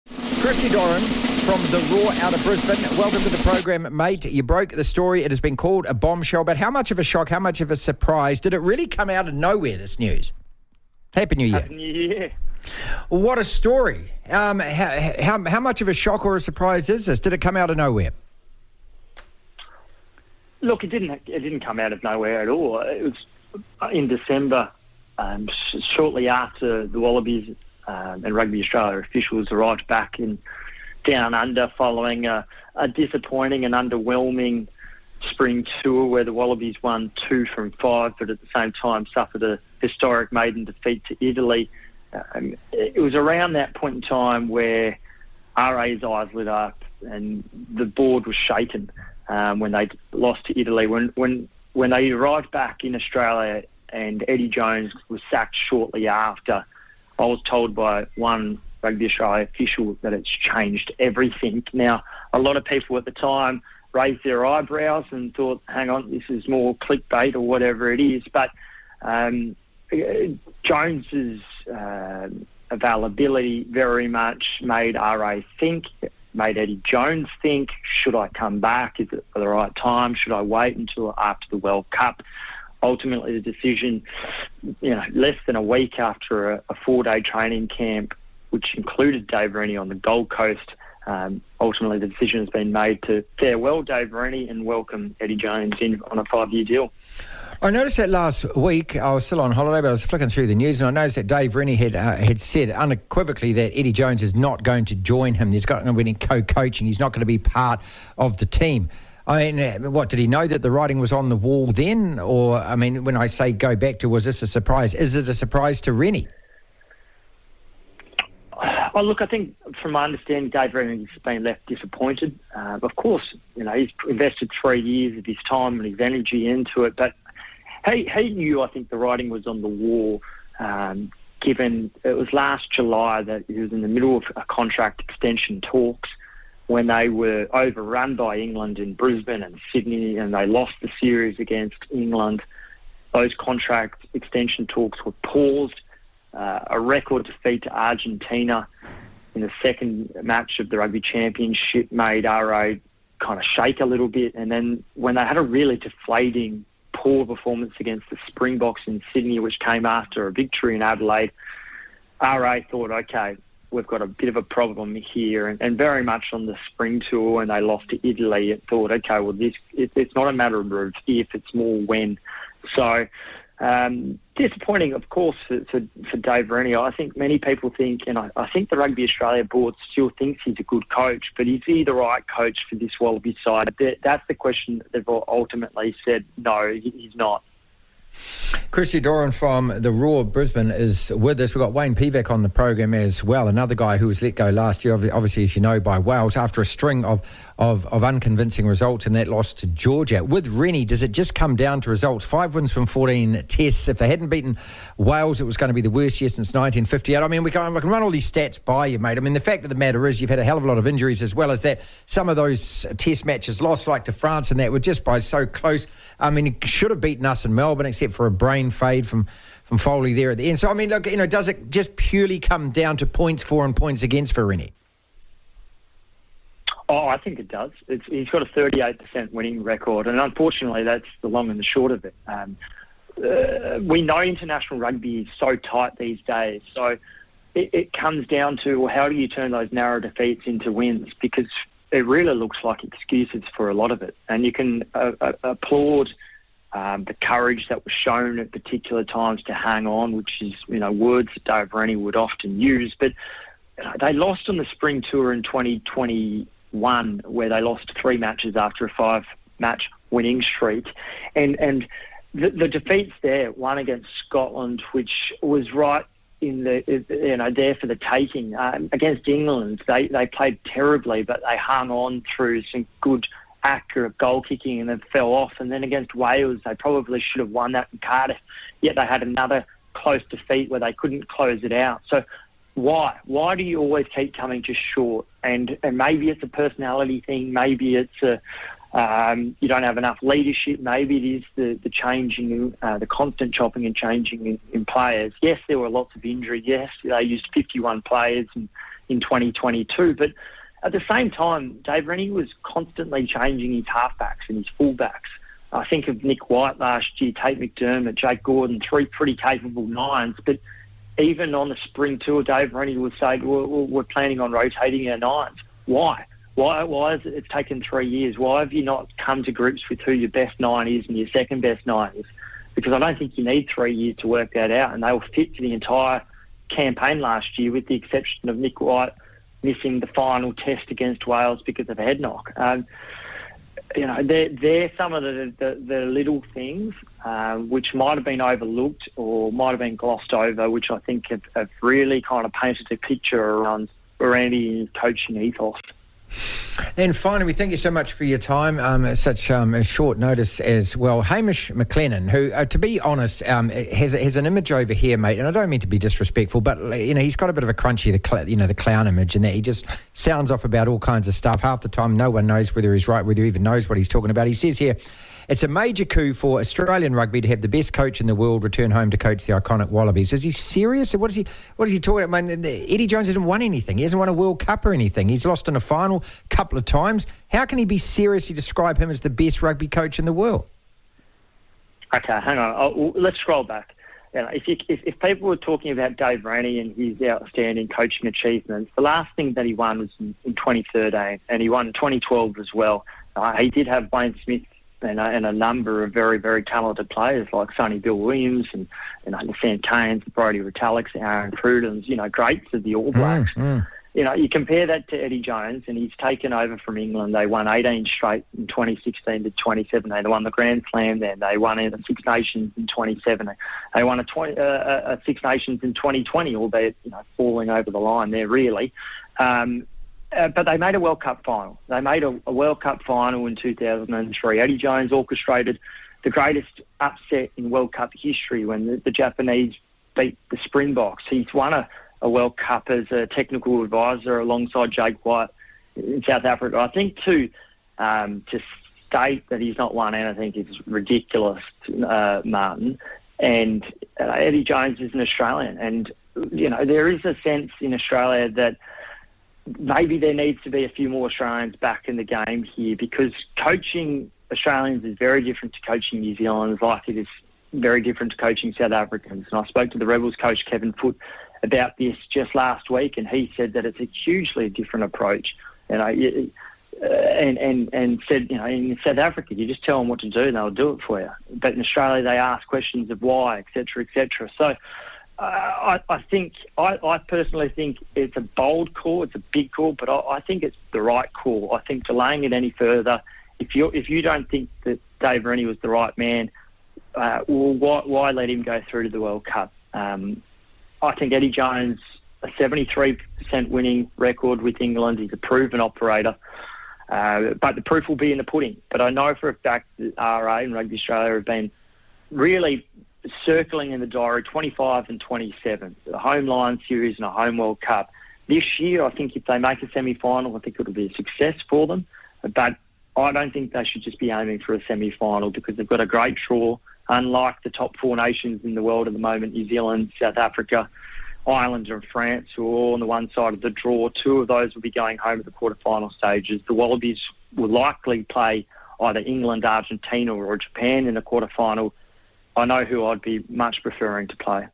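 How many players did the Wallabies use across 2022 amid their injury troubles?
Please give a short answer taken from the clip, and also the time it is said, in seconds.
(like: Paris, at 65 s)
51, at 297 s.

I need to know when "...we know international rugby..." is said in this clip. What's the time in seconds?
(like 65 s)
233 s.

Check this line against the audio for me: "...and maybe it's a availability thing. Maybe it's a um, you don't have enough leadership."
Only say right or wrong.
wrong.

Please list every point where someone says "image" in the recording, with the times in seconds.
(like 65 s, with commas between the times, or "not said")
354 s, 359 s.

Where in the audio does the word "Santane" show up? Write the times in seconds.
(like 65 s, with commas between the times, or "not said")
399 s.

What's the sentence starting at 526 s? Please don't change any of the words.
The Wallabies will likely play either England, Argentina, or Japan in the final I know who I'd be much preferring to play.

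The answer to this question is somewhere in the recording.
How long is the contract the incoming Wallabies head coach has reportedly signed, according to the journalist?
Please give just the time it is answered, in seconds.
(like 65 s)
96 s.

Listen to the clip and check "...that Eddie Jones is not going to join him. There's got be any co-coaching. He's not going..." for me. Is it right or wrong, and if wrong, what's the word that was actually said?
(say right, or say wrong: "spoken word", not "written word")
right.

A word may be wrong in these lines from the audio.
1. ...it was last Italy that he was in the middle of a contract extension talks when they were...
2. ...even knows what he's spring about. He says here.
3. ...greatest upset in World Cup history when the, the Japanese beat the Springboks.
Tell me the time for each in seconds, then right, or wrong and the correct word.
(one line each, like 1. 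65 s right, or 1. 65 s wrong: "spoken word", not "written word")
1. 132 s wrong: "July", not "Italy"
2. 363 s wrong: "talking", not "spring"
3. 426 s right.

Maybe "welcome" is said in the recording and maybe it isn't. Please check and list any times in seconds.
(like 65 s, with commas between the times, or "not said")
2 s, 94 s.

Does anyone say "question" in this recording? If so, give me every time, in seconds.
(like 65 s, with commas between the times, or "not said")
184 s, 472 s.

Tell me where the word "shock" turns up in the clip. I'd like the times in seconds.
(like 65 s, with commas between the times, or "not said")
7 s, 15 s.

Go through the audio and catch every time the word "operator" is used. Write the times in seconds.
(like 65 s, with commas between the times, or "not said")
495 s.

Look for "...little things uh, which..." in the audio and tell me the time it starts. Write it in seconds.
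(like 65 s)
336 s.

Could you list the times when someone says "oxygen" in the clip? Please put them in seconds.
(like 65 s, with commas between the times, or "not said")
not said.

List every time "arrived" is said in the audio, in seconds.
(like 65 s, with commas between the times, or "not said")
29 s, 52 s.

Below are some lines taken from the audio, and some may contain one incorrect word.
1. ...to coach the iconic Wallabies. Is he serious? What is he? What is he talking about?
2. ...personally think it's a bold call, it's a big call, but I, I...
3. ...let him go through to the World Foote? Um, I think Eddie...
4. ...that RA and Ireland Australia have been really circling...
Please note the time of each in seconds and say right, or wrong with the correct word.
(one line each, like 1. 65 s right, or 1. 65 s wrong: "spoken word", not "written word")
1. 369 s right
2. 477 s right
3. 488 s wrong: "Cup", not "Foote"
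4. 499 s wrong: "Rugby", not "Ireland".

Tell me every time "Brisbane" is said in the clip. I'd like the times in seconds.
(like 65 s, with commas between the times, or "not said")
2 s, 138 s, 190 s.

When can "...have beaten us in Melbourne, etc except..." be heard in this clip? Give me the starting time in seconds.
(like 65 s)
216 s.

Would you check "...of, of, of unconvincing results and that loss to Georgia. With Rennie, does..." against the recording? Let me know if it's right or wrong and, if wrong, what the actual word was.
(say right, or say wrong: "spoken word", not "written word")
right.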